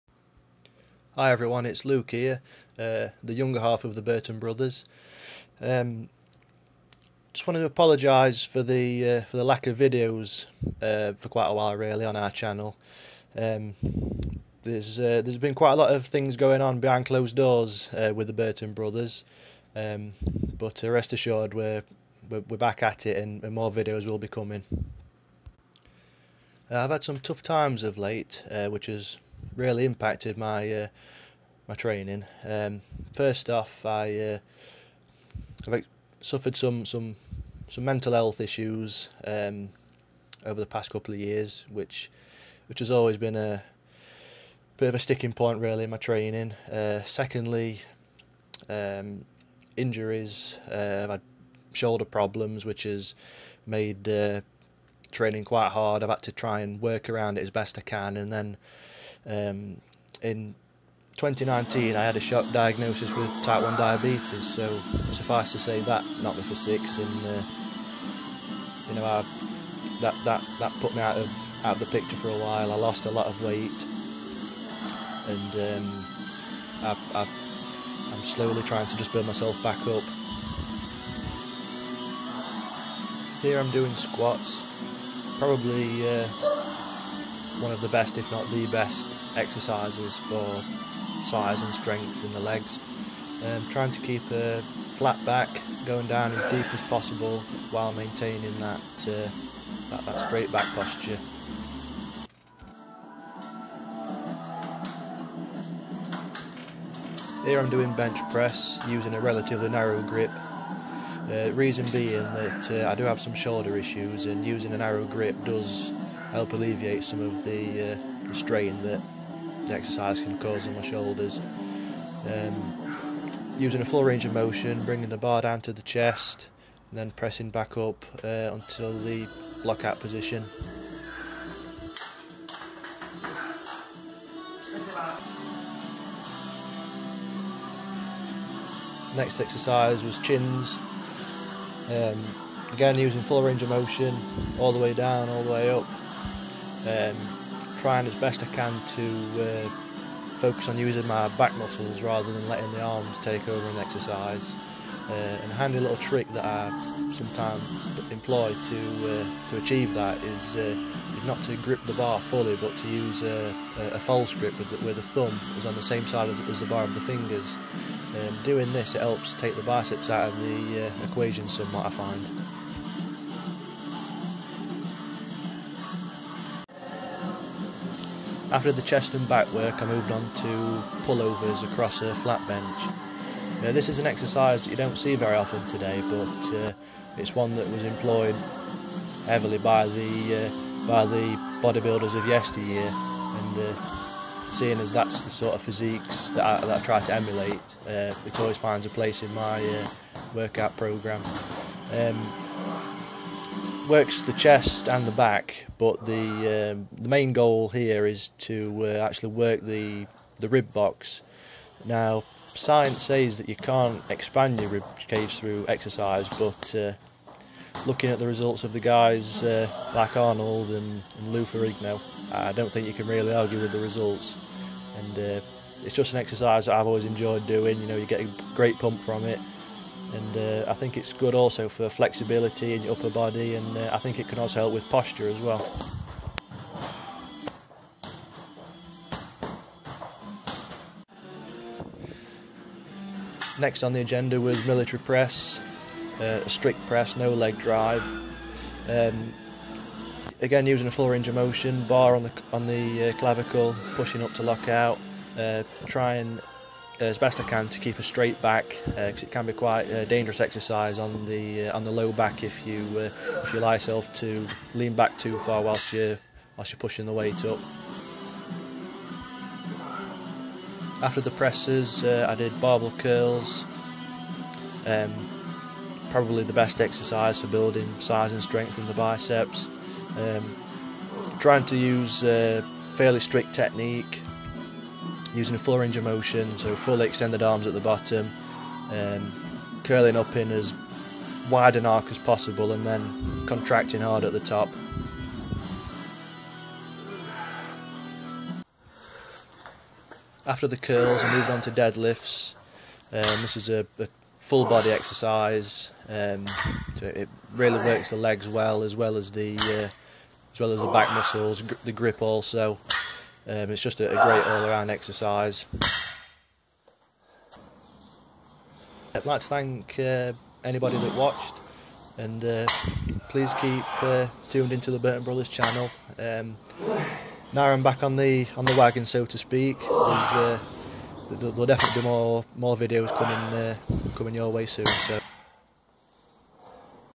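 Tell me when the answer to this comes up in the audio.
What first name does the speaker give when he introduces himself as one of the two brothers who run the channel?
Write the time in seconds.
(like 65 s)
1 s.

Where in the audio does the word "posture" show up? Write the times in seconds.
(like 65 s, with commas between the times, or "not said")
100 s, 234 s.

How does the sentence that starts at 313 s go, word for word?
Um, it's just a, a great all-around exercise.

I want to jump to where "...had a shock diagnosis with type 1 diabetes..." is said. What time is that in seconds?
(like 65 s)
62 s.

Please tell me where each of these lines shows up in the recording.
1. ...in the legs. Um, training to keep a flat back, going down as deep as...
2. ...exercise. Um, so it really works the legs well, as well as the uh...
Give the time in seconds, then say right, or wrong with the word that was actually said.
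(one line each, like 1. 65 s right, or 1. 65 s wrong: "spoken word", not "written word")
1. 92 s wrong: "trying", not "training"
2. 304 s right.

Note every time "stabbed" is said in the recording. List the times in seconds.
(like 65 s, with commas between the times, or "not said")
not said.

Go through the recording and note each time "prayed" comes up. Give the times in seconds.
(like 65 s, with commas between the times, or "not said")
not said.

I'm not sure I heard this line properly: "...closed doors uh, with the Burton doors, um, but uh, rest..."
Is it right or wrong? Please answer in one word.
wrong.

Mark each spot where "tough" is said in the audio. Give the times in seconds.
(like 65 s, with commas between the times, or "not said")
27 s.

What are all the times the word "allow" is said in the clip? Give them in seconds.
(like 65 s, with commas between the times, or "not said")
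263 s.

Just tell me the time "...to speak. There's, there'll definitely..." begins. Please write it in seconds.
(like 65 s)
329 s.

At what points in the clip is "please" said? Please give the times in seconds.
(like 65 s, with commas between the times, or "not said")
323 s.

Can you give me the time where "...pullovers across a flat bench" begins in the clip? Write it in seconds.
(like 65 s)
181 s.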